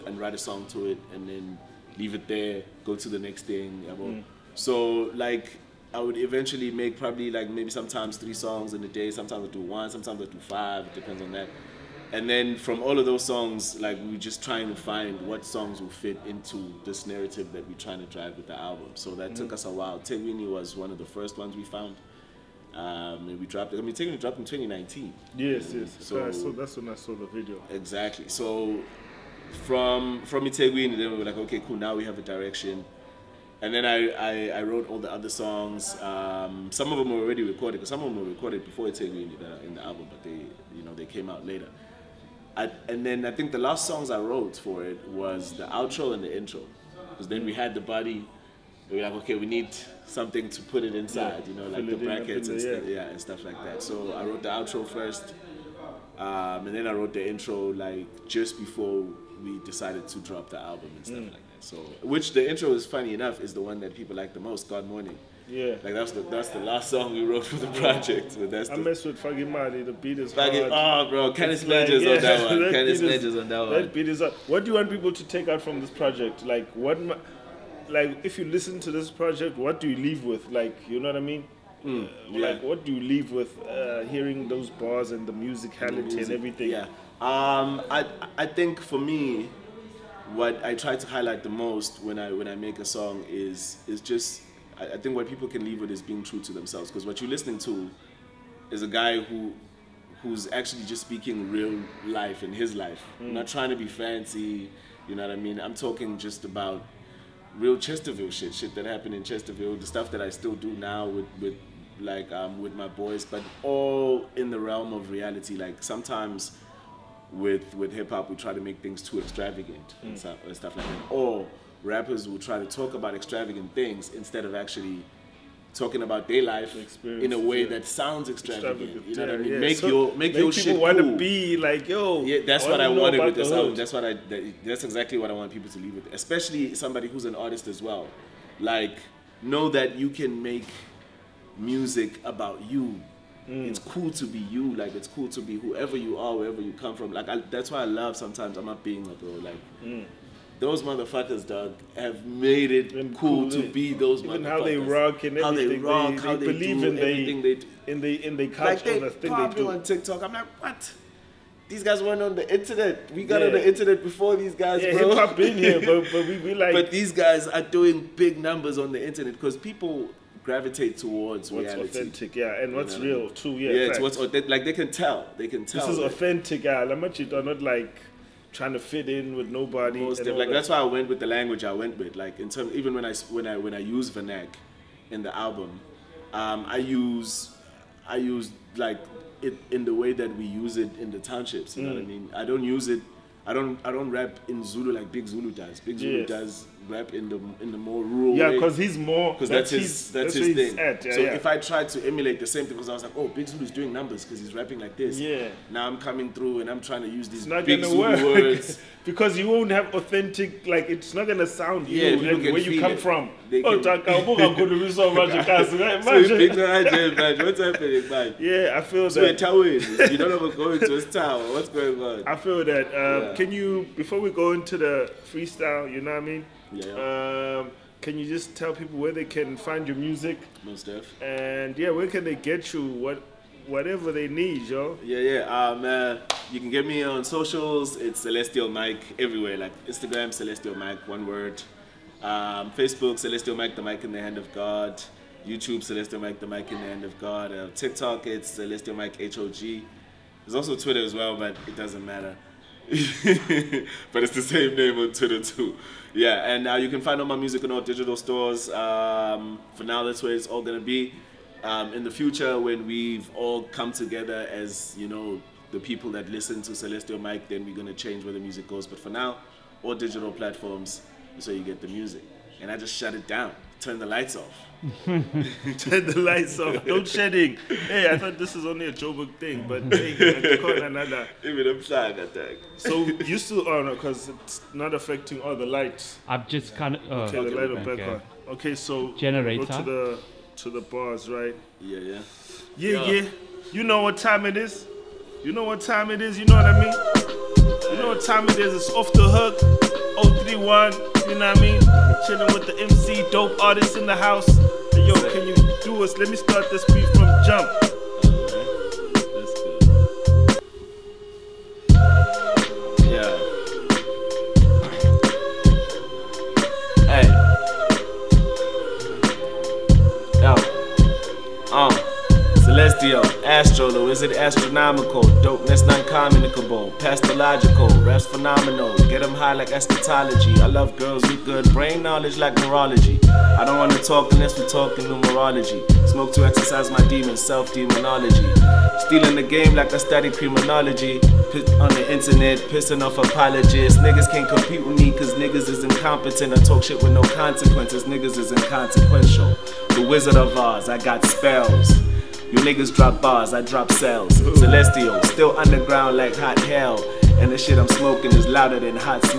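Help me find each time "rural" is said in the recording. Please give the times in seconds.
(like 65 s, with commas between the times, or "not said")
198 s.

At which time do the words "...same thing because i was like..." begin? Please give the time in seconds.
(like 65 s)
202 s.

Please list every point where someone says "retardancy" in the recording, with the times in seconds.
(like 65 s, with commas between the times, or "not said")
not said.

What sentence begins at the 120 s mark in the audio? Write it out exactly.
and, stuff, and stuff like that.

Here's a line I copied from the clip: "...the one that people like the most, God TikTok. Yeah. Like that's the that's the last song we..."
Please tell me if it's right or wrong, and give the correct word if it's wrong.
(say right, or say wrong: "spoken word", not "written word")
wrong: "Morning", not "TikTok".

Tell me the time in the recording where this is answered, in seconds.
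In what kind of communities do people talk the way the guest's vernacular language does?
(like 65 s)
191 s.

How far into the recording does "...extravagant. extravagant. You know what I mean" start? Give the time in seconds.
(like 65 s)
128 s.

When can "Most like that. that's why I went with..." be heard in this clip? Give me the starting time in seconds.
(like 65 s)
179 s.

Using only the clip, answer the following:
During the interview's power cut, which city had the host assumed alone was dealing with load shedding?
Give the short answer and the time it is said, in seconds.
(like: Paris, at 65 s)
Joburg, at 278 s.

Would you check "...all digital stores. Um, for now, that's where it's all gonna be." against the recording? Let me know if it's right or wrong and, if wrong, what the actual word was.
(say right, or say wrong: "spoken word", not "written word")
right.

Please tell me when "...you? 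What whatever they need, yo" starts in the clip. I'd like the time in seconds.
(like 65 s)
232 s.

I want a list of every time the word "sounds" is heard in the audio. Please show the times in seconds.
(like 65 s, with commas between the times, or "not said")
127 s, 211 s.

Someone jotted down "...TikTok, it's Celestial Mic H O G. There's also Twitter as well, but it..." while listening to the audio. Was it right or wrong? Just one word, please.
right.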